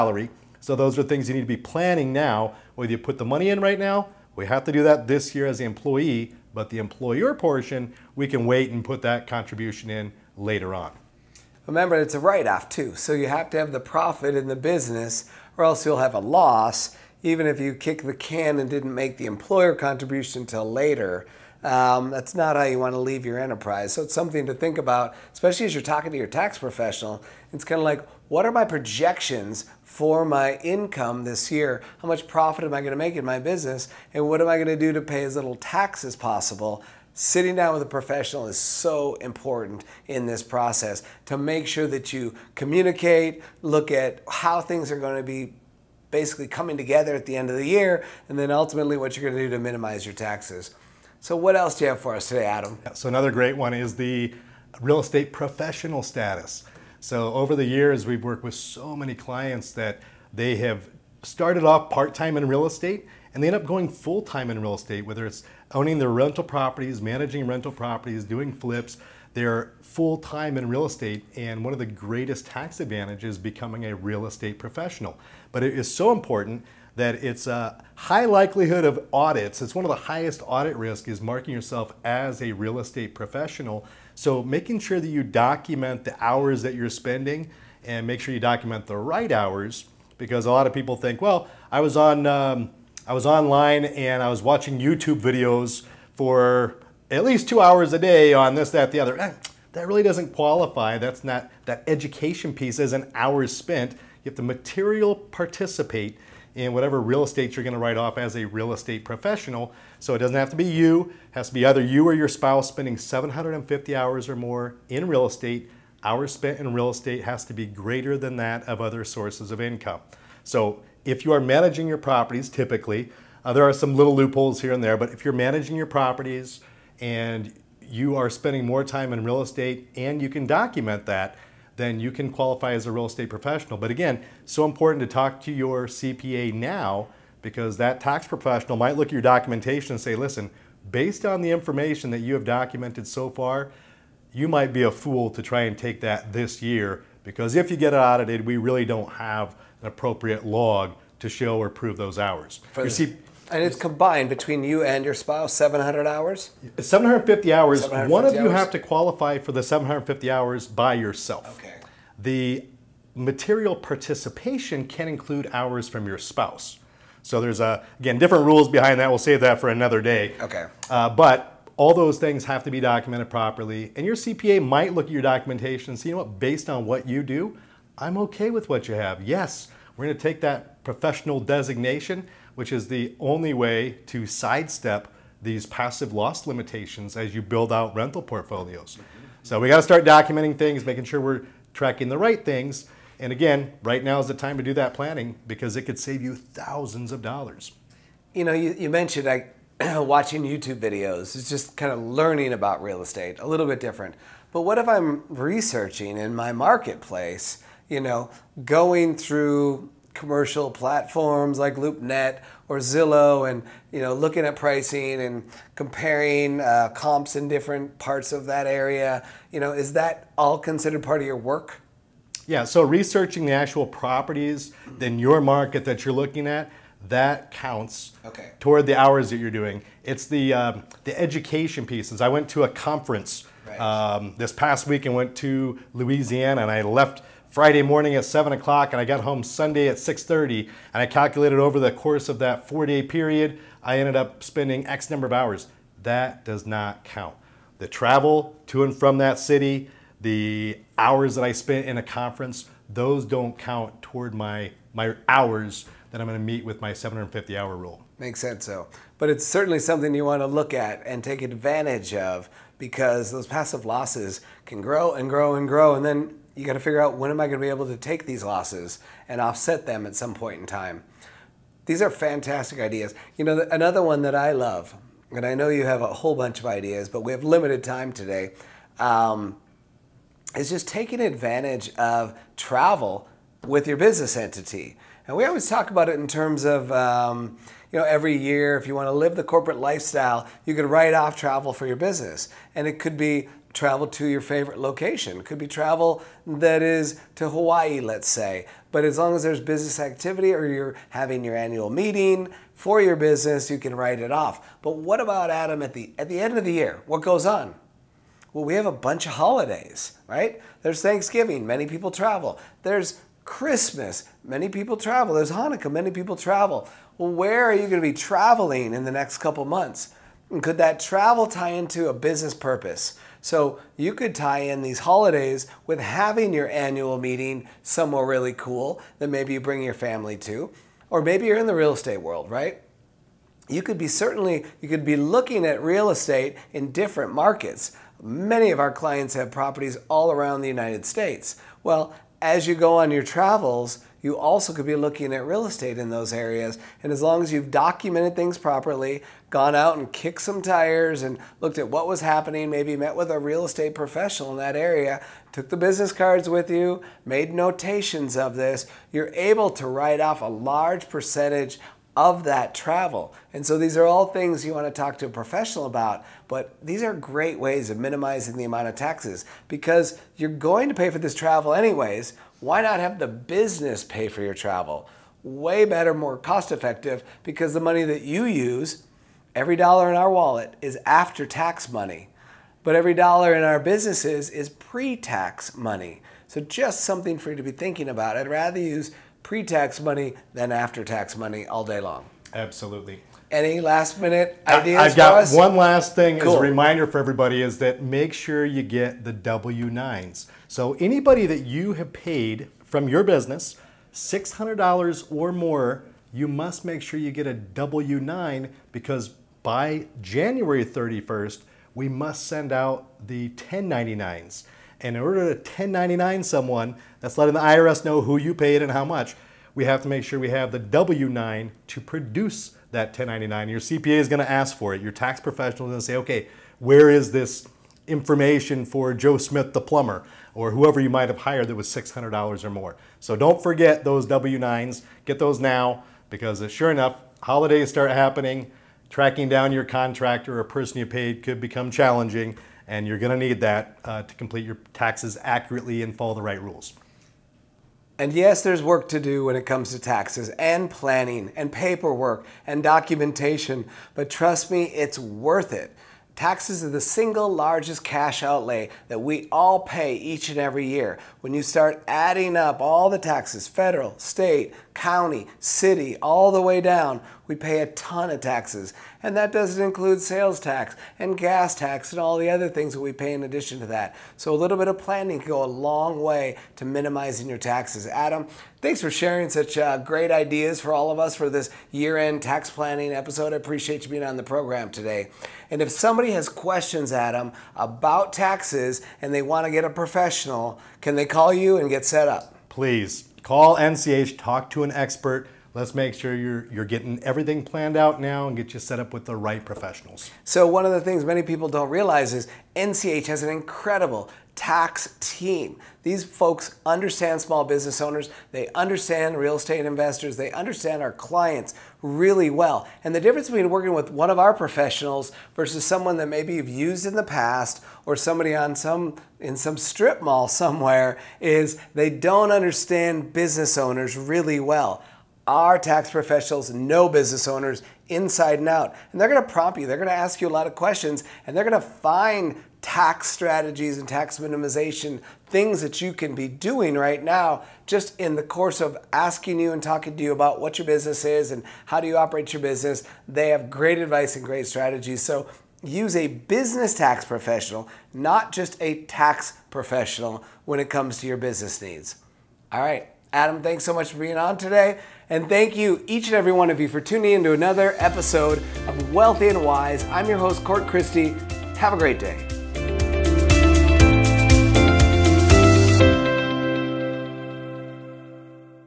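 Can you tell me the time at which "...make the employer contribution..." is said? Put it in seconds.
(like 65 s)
18 s.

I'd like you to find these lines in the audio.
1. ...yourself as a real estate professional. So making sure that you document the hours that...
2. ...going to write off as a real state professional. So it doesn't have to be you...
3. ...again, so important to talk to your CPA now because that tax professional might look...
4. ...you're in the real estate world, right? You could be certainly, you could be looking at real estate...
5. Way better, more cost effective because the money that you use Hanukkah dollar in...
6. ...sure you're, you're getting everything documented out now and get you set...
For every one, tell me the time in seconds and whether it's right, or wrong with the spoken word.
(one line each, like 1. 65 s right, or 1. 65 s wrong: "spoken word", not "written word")
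1. 81 s right
2. 107 s wrong: "estate", not "state"
3. 133 s right
4. 331 s right
5. 375 s wrong: "Every", not "Hanukkah"
6. 496 s wrong: "planned", not "documented".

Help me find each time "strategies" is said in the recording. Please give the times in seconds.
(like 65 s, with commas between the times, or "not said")
533 s, 544 s.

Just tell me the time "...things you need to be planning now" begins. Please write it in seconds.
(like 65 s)
1 s.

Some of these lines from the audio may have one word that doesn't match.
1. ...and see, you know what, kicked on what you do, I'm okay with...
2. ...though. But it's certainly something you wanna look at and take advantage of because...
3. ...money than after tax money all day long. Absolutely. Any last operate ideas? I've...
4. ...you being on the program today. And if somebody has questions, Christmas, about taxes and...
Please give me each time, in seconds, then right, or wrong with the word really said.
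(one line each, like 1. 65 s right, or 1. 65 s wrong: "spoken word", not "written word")
1. 175 s wrong: "based", not "kicked"
2. 258 s right
3. 389 s wrong: "minute", not "operate"
4. 484 s wrong: "Adam", not "Christmas".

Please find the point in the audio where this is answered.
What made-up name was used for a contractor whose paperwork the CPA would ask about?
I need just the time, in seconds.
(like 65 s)
429 s.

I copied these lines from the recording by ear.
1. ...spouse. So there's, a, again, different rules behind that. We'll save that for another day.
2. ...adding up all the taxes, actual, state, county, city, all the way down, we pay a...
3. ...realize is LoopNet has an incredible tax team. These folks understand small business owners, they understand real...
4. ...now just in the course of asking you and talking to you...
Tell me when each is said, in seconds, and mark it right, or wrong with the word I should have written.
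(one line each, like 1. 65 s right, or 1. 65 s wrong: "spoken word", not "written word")
1. 166 s right
2. 462 s wrong: "federal", not "actual"
3. 501 s wrong: "NCH", not "LoopNet"
4. 537 s right.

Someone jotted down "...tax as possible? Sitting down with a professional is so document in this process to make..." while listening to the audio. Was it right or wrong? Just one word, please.
wrong.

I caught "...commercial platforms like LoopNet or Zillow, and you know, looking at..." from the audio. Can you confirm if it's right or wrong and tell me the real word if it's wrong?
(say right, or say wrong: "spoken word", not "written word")
right.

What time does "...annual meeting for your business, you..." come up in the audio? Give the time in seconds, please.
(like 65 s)
301 s.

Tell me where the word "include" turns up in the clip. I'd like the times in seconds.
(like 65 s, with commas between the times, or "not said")
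165 s, 469 s.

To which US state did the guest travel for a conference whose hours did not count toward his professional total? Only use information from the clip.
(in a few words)
Louisiana.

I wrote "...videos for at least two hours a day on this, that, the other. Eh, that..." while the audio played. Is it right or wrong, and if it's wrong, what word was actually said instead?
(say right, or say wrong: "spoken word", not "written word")
right.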